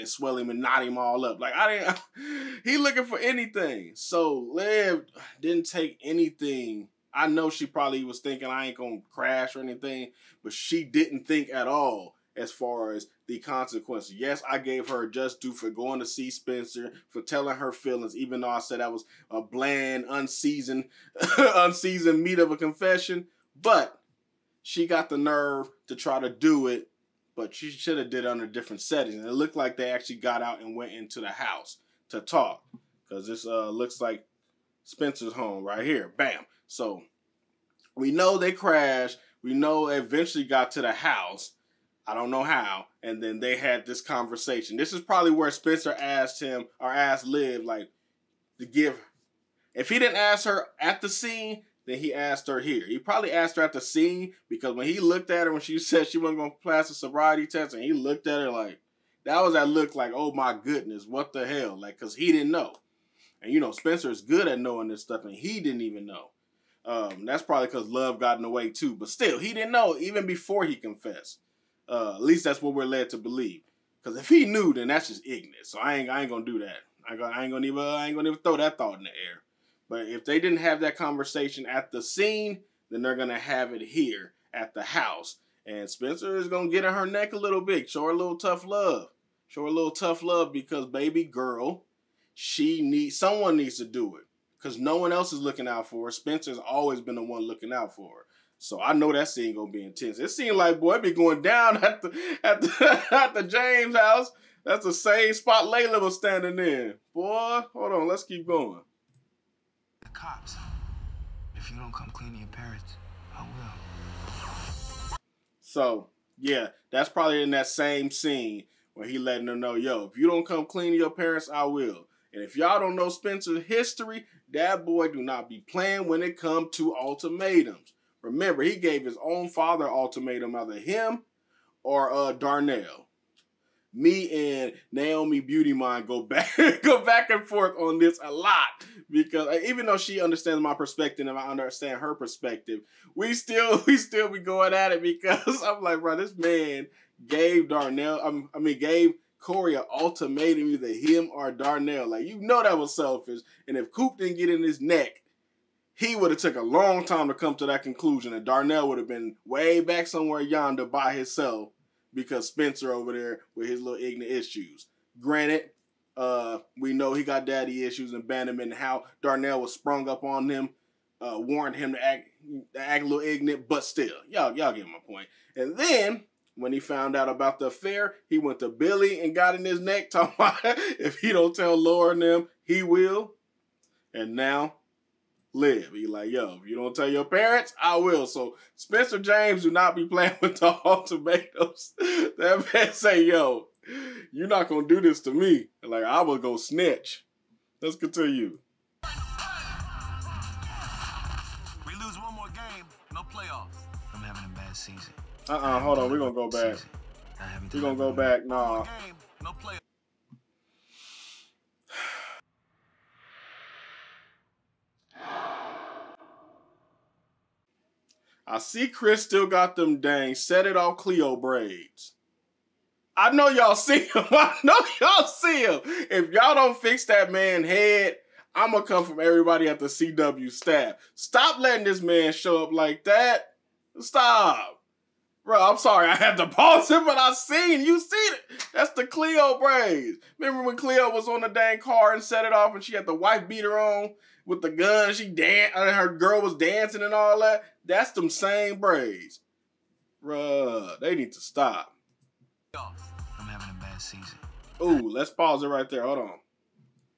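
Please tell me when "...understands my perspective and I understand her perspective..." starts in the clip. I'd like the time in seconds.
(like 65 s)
140 s.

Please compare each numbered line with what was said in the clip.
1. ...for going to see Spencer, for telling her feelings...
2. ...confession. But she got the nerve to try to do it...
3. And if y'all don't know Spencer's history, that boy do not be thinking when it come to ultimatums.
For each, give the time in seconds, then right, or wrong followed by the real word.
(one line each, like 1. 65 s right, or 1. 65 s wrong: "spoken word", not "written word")
1. 15 s right
2. 22 s right
3. 122 s wrong: "playing", not "thinking".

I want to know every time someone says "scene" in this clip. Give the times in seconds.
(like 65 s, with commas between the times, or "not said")
51 s, 82 s, 99 s, 118 s.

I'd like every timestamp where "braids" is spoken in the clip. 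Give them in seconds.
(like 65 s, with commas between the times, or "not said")
221 s, 239 s, 248 s.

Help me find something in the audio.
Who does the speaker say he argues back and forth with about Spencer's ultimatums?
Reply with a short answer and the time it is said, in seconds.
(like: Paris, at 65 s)
Naomi Beauty Mind, at 134 s.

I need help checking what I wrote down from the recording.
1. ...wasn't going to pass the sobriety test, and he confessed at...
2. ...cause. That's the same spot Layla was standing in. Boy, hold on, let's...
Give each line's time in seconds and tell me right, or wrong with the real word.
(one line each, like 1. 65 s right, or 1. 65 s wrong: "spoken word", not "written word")
1. 56 s wrong: "looked", not "confessed"
2. 103 s wrong: "house", not "cause".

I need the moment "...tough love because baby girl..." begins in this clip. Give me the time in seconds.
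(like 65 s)
89 s.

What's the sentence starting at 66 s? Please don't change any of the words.
Um, that's probably because love got in the way too.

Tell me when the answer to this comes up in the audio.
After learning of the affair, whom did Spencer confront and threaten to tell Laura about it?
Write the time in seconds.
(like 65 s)
178 s.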